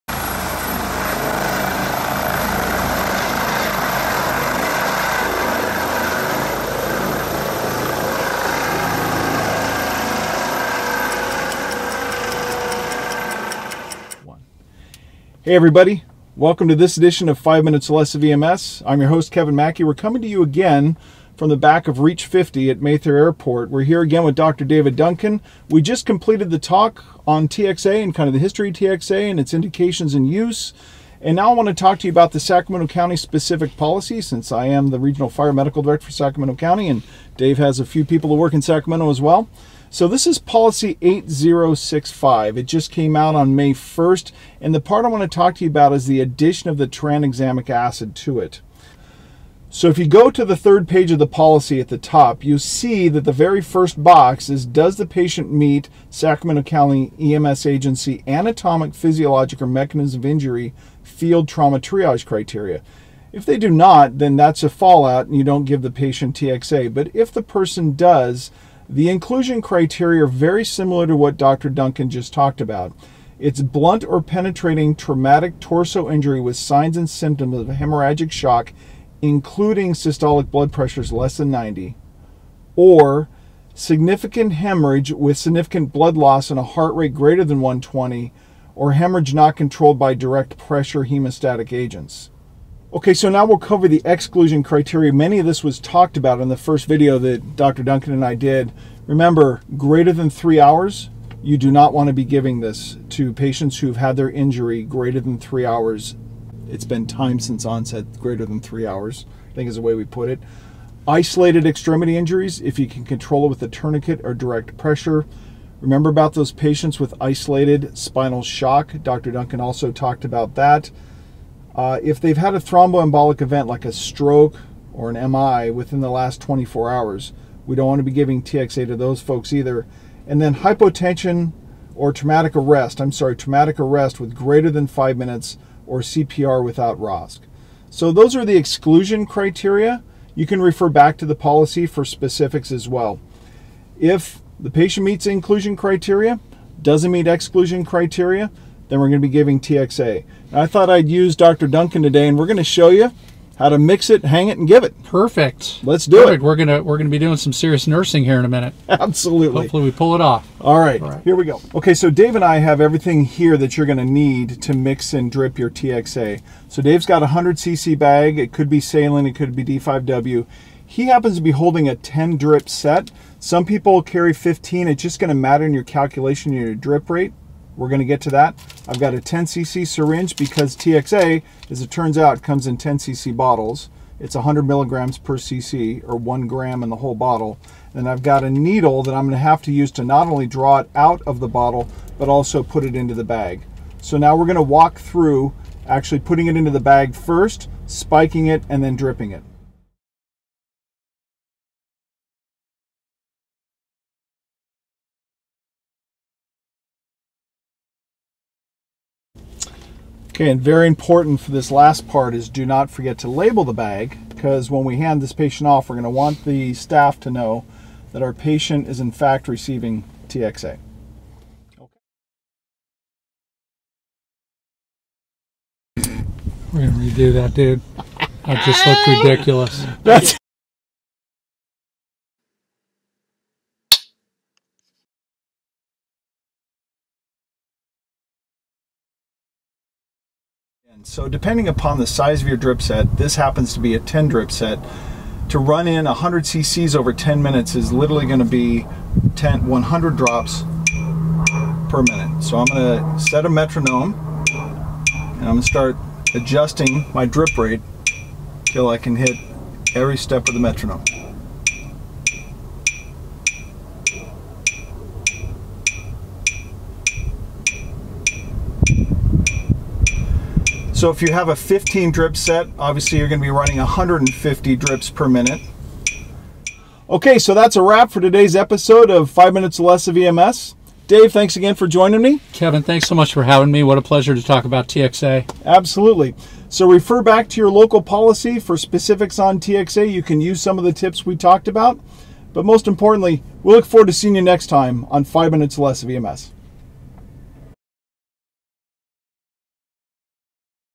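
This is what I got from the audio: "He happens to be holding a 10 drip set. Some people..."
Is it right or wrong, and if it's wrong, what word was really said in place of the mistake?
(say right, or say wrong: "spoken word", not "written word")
right.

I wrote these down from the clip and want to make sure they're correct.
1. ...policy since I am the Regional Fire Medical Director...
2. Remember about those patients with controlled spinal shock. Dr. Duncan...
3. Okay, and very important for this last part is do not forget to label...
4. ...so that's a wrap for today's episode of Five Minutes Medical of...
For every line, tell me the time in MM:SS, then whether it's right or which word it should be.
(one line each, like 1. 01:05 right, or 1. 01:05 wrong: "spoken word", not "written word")
1. 00:33 right
2. 01:55 wrong: "isolated", not "controlled"
3. 03:30 right
4. 04:37 wrong: "Less", not "Medical".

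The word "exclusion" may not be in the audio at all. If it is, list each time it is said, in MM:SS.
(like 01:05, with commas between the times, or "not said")
01:34, 02:18, 02:27.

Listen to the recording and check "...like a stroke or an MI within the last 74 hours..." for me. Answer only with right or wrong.
wrong.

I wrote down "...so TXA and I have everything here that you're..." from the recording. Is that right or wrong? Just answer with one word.
wrong.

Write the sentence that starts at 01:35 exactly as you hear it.
Many of this was talked about in the first video that Dr.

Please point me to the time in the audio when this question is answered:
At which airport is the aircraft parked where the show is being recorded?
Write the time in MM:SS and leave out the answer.
00:22.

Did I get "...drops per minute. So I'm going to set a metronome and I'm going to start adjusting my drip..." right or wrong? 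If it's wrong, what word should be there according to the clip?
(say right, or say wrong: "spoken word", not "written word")
right.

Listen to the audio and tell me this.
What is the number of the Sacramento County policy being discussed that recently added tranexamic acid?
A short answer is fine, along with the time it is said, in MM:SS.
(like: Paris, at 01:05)
8065, at 00:41.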